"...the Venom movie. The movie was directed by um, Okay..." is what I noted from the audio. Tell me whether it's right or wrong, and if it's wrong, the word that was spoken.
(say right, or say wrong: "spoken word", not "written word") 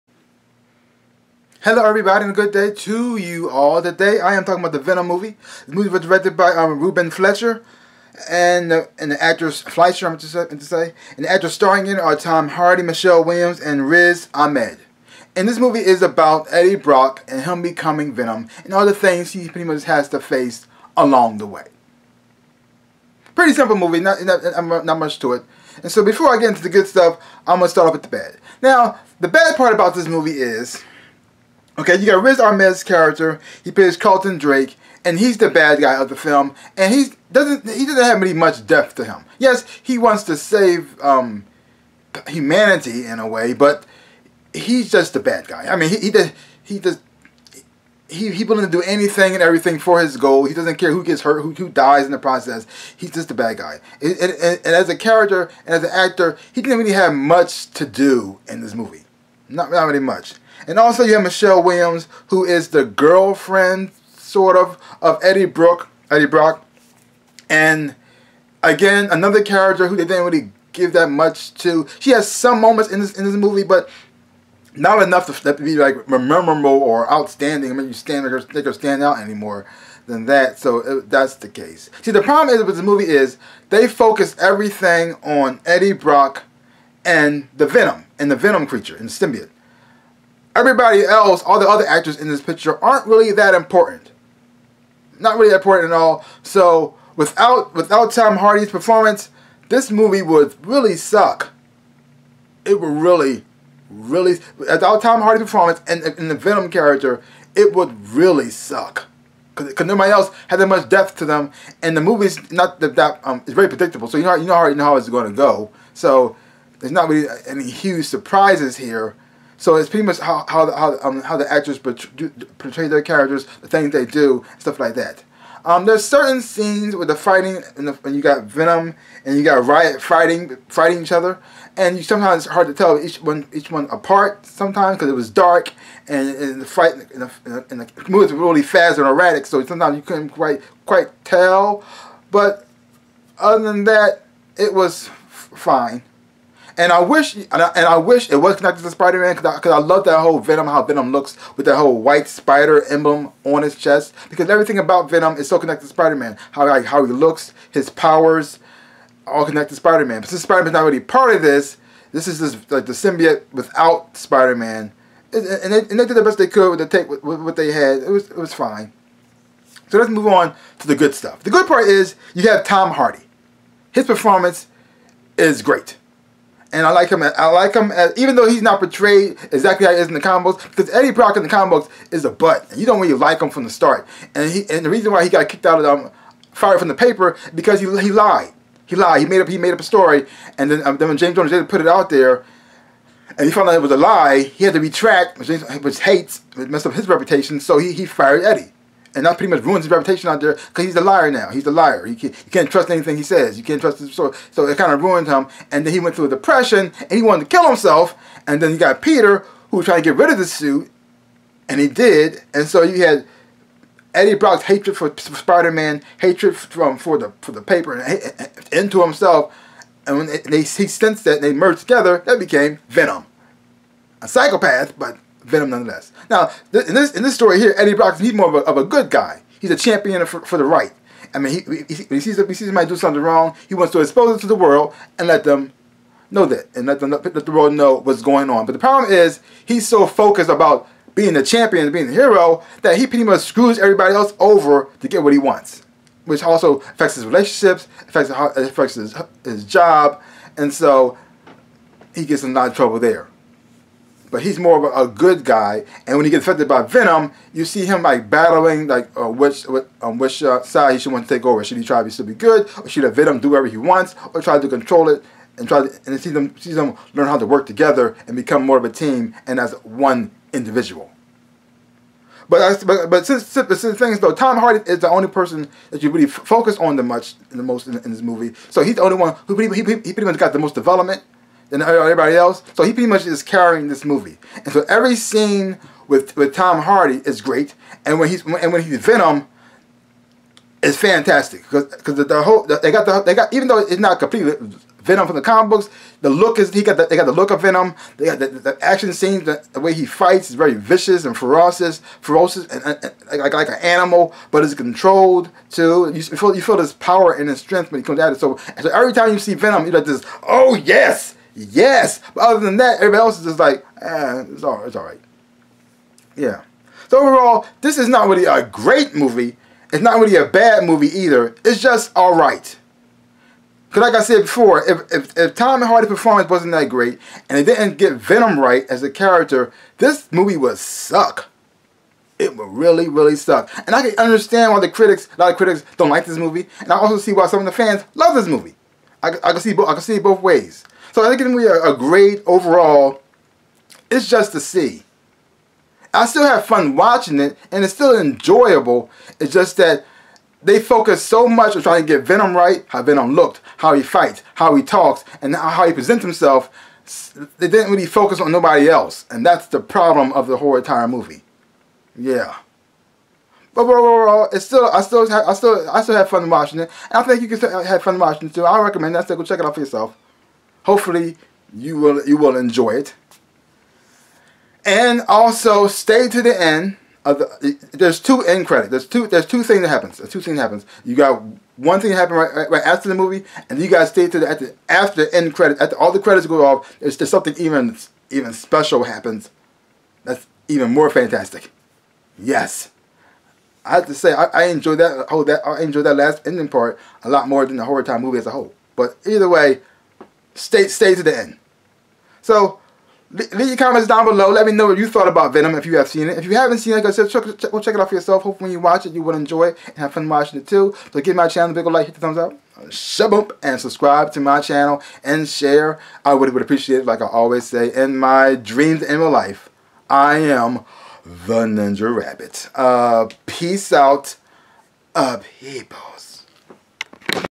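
wrong: "Ruben", not "Okay".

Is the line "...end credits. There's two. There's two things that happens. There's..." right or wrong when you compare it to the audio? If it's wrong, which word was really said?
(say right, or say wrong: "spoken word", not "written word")
right.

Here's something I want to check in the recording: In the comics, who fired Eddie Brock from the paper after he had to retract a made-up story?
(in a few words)
James Jones.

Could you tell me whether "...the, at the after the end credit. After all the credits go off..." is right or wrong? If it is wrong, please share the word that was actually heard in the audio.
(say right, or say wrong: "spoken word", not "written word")
right.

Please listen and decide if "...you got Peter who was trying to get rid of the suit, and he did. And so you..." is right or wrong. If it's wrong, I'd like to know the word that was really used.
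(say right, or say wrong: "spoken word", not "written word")
right.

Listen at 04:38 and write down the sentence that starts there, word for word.
So he's the only one who pretty, he, he pretty much got the most development than everybody else.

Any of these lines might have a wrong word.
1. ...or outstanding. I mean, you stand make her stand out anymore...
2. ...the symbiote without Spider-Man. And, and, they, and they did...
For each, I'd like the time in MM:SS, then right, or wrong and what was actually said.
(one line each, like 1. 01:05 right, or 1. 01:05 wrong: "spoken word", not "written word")
1. 01:16 right
2. 02:42 right.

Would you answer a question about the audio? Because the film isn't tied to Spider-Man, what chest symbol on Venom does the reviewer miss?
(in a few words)
white spider emblem.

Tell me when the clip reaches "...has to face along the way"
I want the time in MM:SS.
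00:19.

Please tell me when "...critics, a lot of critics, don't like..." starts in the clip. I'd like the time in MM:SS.
05:34.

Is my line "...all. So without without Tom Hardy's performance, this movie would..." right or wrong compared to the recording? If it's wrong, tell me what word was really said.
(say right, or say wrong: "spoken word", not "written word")
right.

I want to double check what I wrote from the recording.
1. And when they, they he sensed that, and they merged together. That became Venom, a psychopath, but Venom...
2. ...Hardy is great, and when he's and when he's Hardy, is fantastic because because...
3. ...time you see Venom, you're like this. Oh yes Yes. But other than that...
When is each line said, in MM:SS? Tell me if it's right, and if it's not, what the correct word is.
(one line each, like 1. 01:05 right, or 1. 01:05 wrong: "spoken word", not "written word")
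1. 03:40 right
2. 04:46 wrong: "Venom", not "Hardy"
3. 05:09 right.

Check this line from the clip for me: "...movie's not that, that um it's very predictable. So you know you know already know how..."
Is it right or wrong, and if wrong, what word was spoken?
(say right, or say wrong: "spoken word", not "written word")
right.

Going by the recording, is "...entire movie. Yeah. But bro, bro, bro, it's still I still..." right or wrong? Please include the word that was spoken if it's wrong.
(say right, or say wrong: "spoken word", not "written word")
right.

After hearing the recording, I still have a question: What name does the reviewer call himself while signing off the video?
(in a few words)
the Ninja Rabbit.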